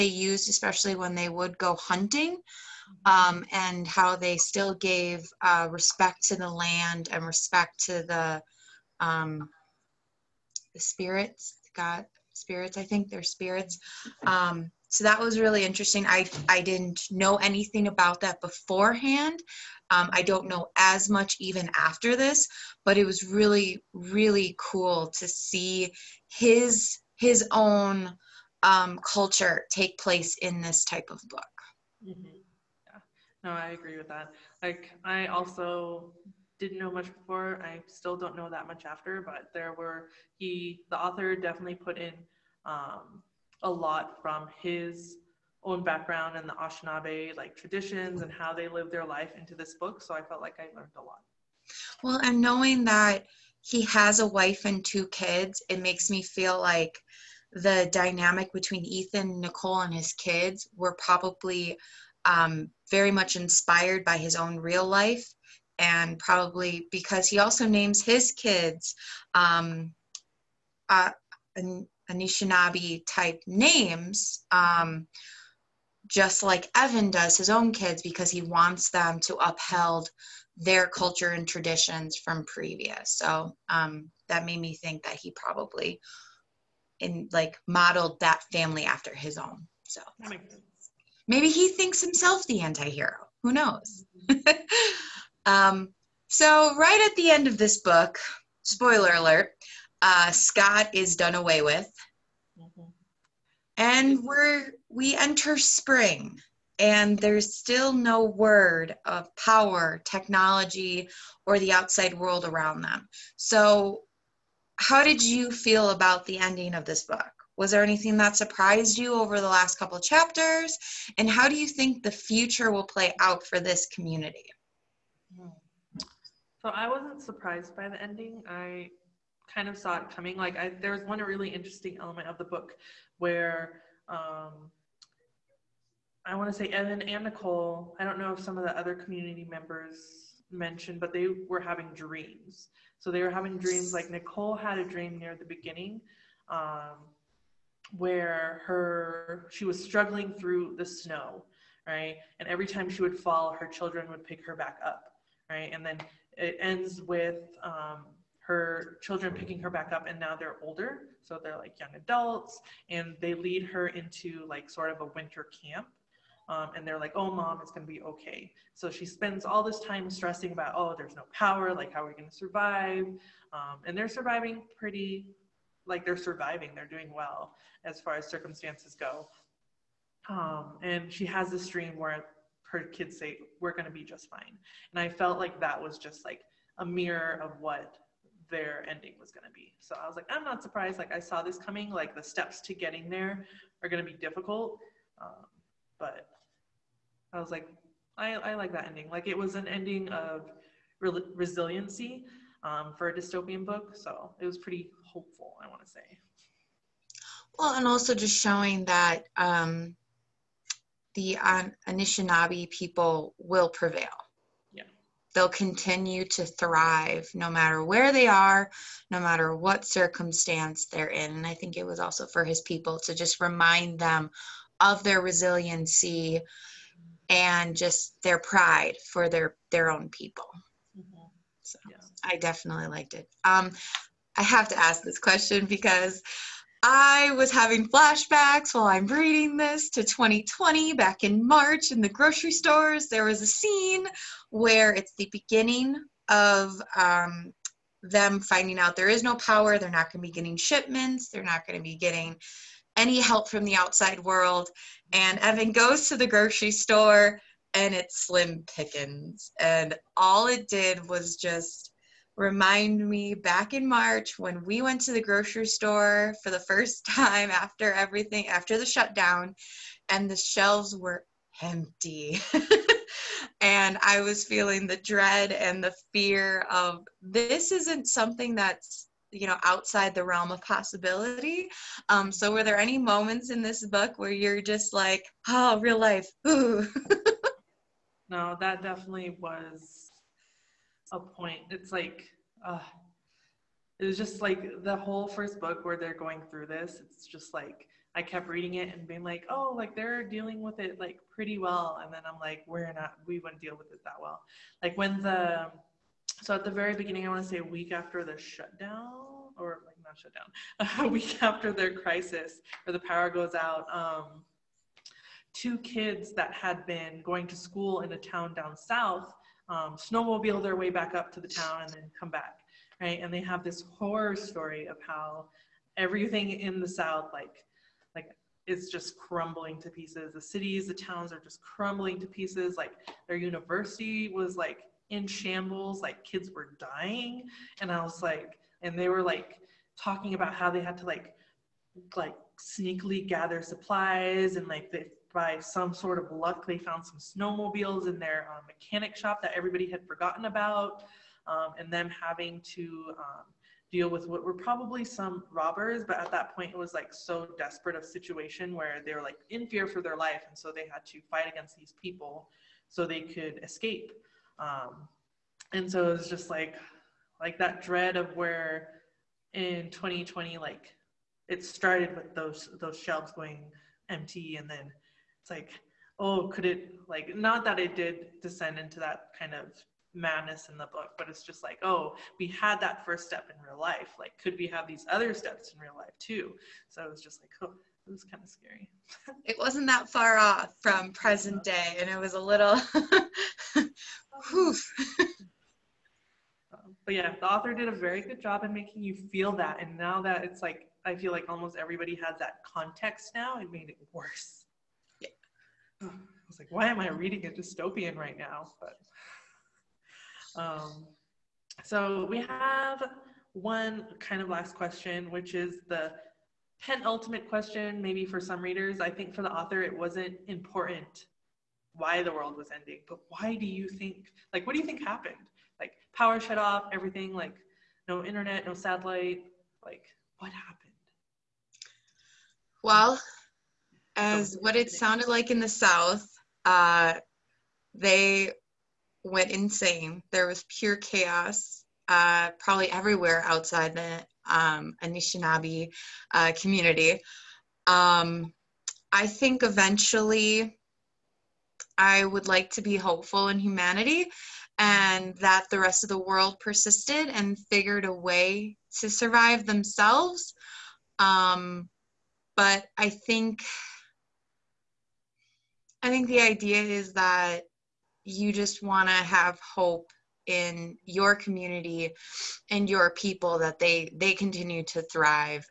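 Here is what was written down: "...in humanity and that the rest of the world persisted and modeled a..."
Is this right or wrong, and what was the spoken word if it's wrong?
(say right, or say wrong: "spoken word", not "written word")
wrong: "figured", not "modeled".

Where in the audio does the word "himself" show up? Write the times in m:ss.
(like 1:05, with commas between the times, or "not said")
1:32.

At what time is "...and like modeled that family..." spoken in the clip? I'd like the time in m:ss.
1:27.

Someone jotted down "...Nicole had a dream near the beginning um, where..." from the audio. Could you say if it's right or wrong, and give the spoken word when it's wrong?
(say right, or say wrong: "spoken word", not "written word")
right.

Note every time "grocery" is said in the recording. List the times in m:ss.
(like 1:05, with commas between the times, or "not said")
4:02, 4:16, 4:25.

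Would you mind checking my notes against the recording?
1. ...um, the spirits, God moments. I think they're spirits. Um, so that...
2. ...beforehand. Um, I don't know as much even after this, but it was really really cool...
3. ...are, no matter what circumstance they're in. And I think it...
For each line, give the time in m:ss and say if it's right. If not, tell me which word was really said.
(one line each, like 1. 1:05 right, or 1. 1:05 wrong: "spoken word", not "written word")
1. 0:09 wrong: "spirits", not "moments"
2. 0:18 right
3. 3:38 right.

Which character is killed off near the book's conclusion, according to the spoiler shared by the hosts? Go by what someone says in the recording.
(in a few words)
Scott.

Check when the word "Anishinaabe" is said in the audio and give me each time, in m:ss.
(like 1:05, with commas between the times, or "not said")
0:46, 1:12, 3:31, 7:25.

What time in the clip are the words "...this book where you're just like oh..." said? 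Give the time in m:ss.
4:43.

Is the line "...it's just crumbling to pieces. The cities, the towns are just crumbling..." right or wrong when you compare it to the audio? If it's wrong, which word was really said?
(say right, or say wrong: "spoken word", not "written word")
right.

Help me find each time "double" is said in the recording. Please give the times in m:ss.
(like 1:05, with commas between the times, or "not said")
not said.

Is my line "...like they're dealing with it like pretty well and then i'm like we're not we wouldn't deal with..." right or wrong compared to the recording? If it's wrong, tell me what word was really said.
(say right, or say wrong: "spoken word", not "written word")
right.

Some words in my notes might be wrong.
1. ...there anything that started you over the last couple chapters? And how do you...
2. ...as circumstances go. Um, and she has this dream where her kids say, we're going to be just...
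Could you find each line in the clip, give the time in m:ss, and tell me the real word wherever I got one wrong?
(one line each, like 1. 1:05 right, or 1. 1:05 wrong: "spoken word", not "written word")
1. 1:57 wrong: "surprised", not "started"
2. 2:58 right.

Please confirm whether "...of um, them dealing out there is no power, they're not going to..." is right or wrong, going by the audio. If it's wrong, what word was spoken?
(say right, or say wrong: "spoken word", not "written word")
wrong: "finding", not "dealing".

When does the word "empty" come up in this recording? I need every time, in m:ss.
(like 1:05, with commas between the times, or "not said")
4:31, 6:14.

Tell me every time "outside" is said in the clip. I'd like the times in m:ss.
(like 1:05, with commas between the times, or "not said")
1:51, 4:13, 4:39, 7:23.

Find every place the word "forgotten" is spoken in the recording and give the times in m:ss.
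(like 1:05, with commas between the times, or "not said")
5:50.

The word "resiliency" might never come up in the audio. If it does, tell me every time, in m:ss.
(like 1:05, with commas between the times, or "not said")
3:21, 3:45.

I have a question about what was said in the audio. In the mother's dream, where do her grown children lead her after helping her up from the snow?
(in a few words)
a winter camp.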